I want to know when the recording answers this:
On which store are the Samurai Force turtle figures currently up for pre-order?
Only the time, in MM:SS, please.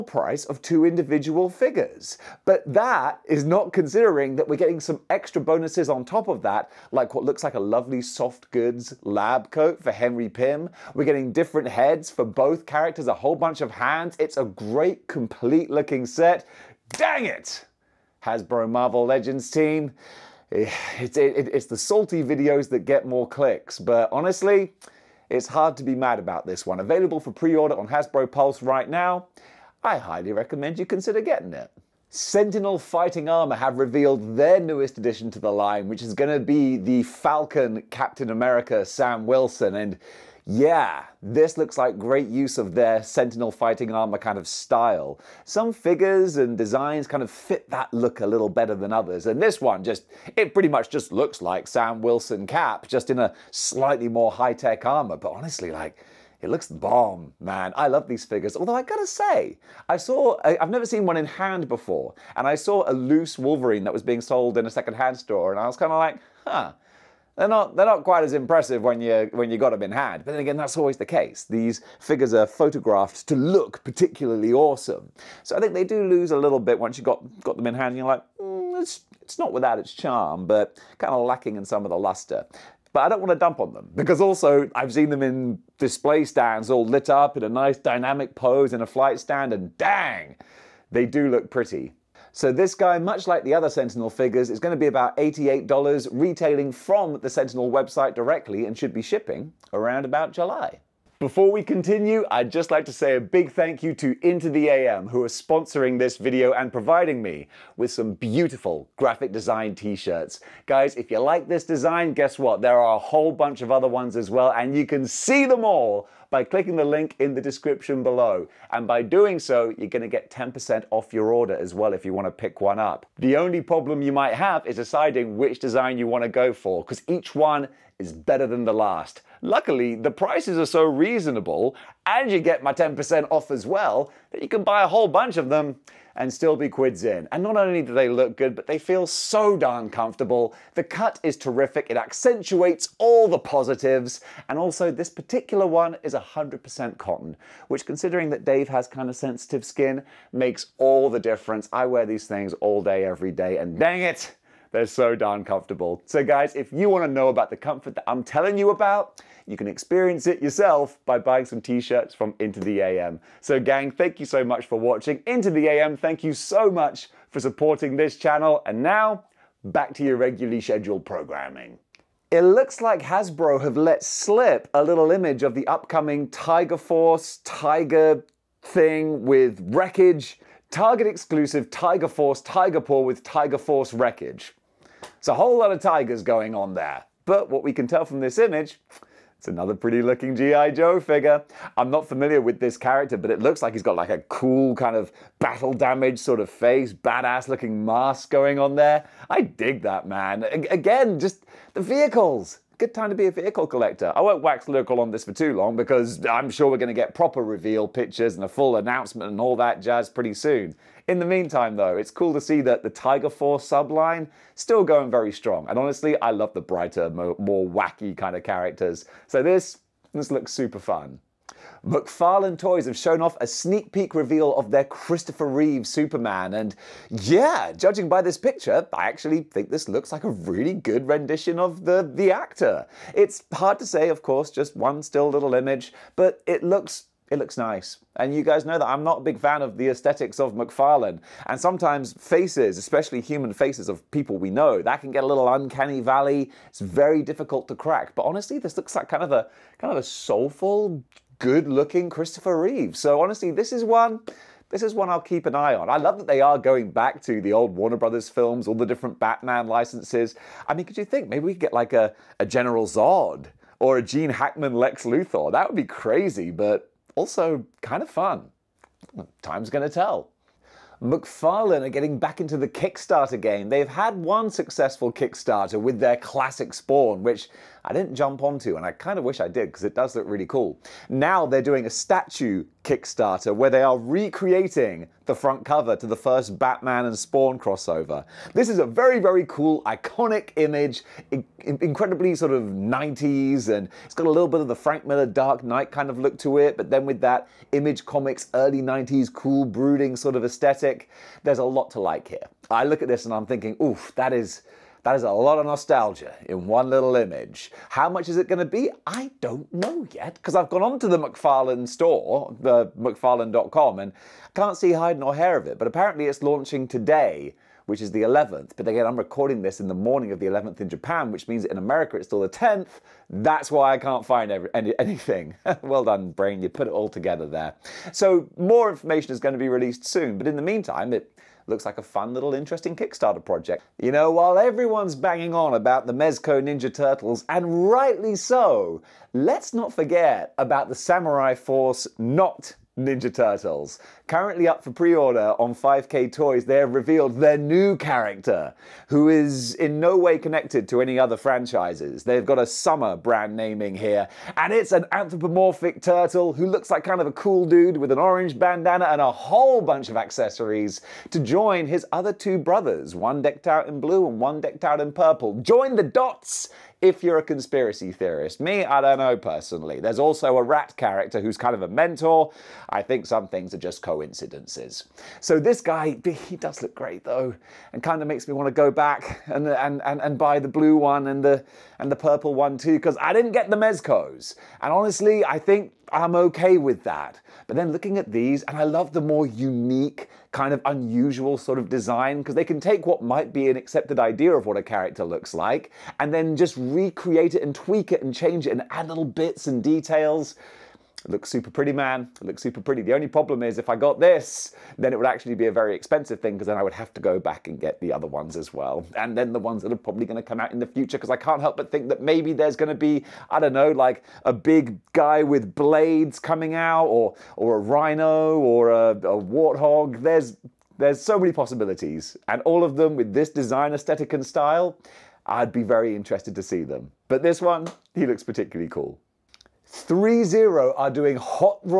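05:45.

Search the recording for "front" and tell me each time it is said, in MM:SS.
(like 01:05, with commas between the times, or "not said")
04:45.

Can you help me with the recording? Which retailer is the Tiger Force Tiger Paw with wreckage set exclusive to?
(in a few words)
Target.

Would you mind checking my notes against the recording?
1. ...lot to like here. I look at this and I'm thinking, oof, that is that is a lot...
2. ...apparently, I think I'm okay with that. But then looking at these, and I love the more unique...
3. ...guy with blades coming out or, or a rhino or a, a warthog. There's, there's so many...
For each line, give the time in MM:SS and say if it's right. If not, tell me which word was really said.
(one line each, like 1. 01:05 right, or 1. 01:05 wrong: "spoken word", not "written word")
1. 05:01 right
2. 06:24 wrong: "honestly", not "apparently"
3. 06:55 right.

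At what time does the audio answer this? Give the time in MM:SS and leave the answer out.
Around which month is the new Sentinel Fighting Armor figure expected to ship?
01:40.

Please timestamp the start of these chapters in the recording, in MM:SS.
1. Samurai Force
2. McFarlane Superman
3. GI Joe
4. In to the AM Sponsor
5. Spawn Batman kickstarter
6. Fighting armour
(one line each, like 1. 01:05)
1. 05:32
2. 03:40
3. 02:51
4. 01:42
5. 04:29
6. 00:31.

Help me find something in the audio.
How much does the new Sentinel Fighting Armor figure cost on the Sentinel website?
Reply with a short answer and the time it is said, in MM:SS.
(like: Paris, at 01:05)
$88, at 01:35.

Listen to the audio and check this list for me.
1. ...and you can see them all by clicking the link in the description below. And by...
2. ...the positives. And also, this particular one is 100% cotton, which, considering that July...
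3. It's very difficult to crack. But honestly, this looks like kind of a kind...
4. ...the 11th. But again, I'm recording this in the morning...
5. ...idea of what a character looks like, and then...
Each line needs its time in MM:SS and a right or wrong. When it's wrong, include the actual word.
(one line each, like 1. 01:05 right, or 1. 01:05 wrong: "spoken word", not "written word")
1. 01:54 right
2. 02:23 wrong: "Dave", not "July"
3. 04:06 right
4. 05:18 right
5. 06:34 right.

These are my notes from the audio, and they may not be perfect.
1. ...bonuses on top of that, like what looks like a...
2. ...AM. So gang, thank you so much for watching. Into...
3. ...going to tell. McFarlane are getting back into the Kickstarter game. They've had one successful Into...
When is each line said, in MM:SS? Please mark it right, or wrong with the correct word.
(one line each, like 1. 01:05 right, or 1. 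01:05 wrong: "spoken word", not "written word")
1. 00:05 right
2. 02:42 right
3. 04:29 wrong: "Kickstarter", not "Into".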